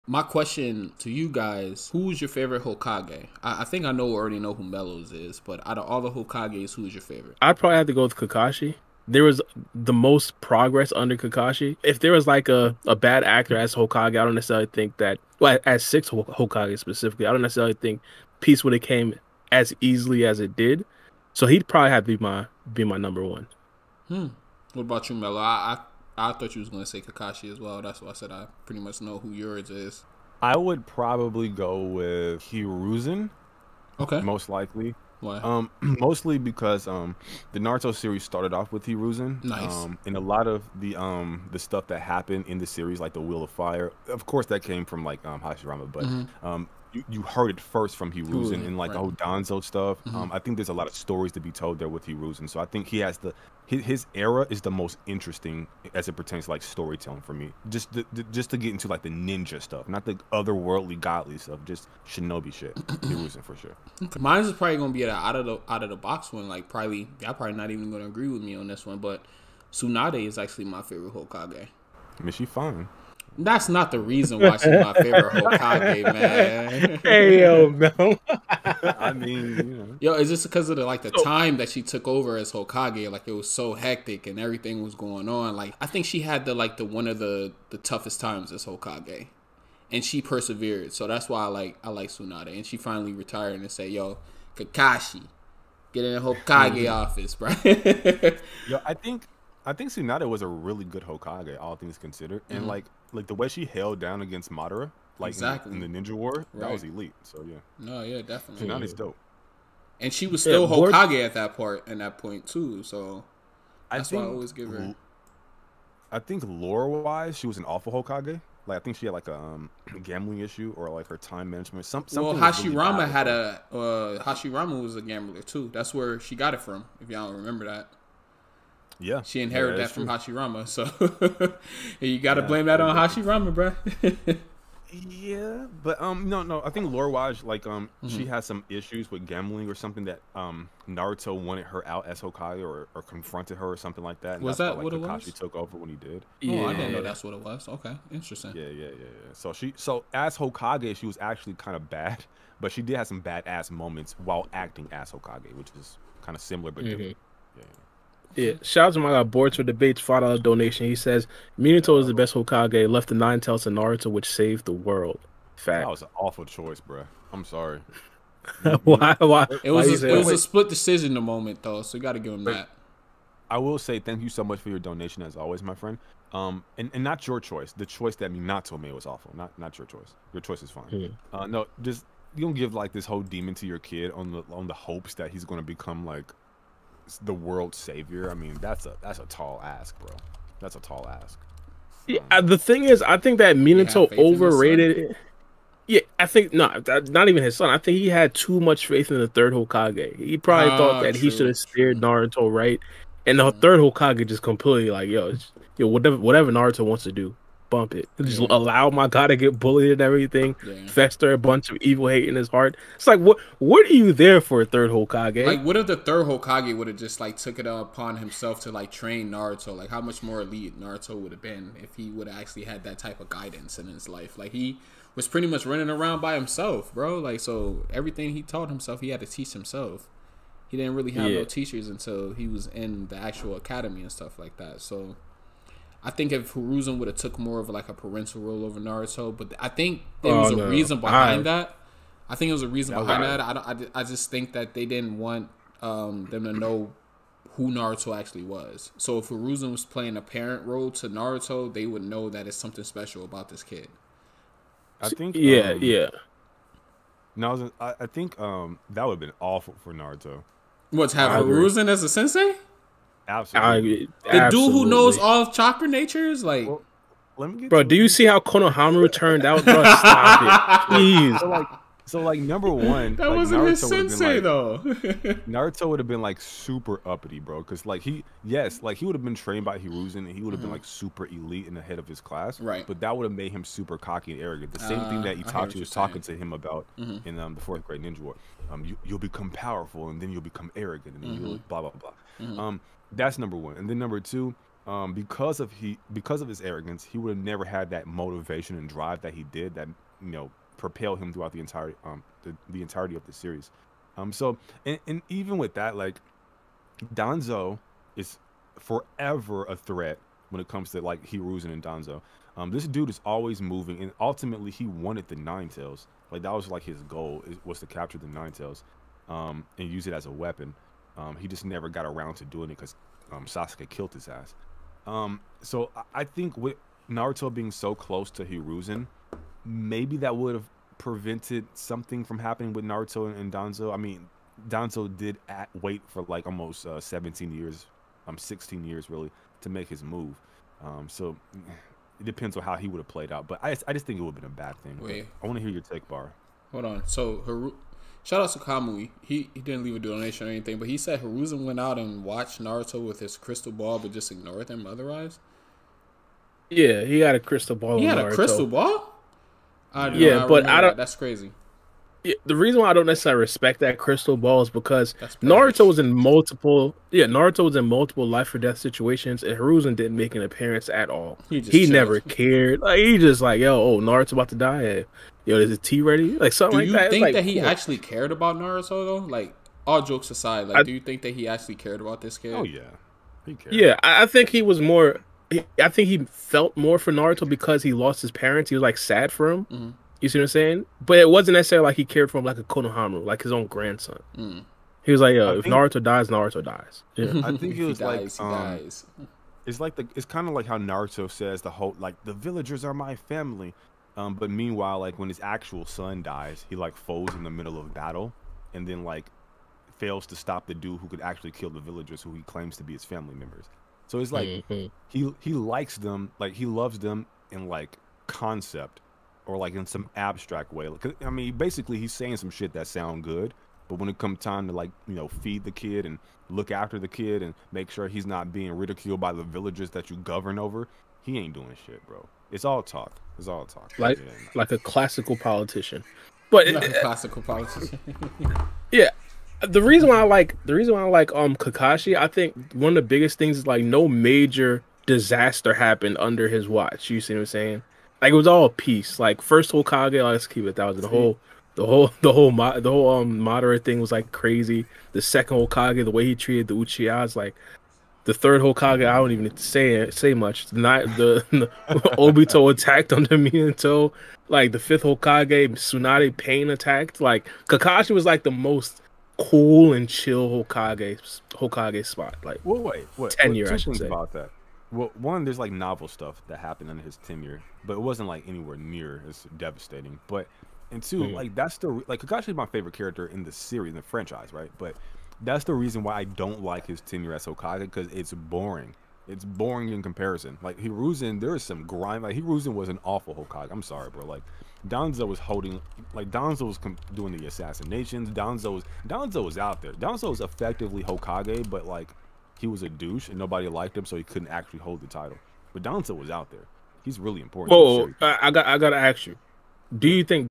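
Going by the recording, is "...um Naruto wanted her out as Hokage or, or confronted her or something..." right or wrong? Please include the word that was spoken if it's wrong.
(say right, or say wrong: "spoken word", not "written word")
right.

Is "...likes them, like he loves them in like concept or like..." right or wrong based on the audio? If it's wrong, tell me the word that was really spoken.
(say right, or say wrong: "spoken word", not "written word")
right.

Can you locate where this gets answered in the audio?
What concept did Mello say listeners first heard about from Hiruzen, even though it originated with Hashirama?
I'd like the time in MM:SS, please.
00:43.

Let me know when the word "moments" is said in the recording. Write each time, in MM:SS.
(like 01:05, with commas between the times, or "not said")
02:33, 02:51.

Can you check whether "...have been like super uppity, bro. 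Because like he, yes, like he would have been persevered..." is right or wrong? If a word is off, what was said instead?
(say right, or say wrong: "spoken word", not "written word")
wrong: "trained", not "persevered".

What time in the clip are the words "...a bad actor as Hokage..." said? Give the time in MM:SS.
00:12.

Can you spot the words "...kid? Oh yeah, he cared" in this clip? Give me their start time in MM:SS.
06:22.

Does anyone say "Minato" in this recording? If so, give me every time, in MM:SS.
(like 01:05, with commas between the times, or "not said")
02:41, 02:58, 03:13, 07:43.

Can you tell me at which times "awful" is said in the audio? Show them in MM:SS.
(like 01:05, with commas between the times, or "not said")
01:57, 02:46, 02:59, 04:19, 08:13.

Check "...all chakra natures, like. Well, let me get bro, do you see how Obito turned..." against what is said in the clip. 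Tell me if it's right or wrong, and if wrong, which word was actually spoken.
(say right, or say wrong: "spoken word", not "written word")
wrong: "Konohamaru", not "Obito".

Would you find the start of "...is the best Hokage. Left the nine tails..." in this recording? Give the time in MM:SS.
02:41.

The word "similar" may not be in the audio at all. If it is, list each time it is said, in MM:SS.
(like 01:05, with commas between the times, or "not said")
02:36.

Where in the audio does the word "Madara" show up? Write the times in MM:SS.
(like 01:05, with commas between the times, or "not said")
01:44, 07:33.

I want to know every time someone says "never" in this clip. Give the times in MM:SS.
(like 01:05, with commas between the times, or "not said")
04:57, 05:21, 06:11.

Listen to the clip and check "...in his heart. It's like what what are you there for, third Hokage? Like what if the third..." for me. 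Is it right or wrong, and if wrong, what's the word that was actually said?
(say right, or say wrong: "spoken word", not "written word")
right.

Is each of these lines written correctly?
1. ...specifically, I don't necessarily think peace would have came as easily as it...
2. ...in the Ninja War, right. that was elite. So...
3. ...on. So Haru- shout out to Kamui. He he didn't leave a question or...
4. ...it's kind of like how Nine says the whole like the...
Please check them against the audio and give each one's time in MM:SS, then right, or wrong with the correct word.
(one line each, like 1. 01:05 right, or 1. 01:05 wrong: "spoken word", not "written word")
1. 00:16 right
2. 01:45 right
3. 05:46 wrong: "donation", not "question"
4. 06:40 wrong: "Naruto", not "Nine".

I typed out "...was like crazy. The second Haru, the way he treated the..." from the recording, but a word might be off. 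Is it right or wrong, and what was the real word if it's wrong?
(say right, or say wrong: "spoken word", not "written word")
wrong: "Hokage", not "Haru".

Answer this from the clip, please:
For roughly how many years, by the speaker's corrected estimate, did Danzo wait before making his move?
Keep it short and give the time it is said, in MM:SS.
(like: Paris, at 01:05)
16 years, at 05:38.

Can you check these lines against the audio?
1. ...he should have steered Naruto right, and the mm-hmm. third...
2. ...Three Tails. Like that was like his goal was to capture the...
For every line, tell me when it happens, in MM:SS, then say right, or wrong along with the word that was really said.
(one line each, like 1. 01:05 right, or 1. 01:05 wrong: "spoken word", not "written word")
1. 03:21 right
2. 05:15 wrong: "Nine", not "Three".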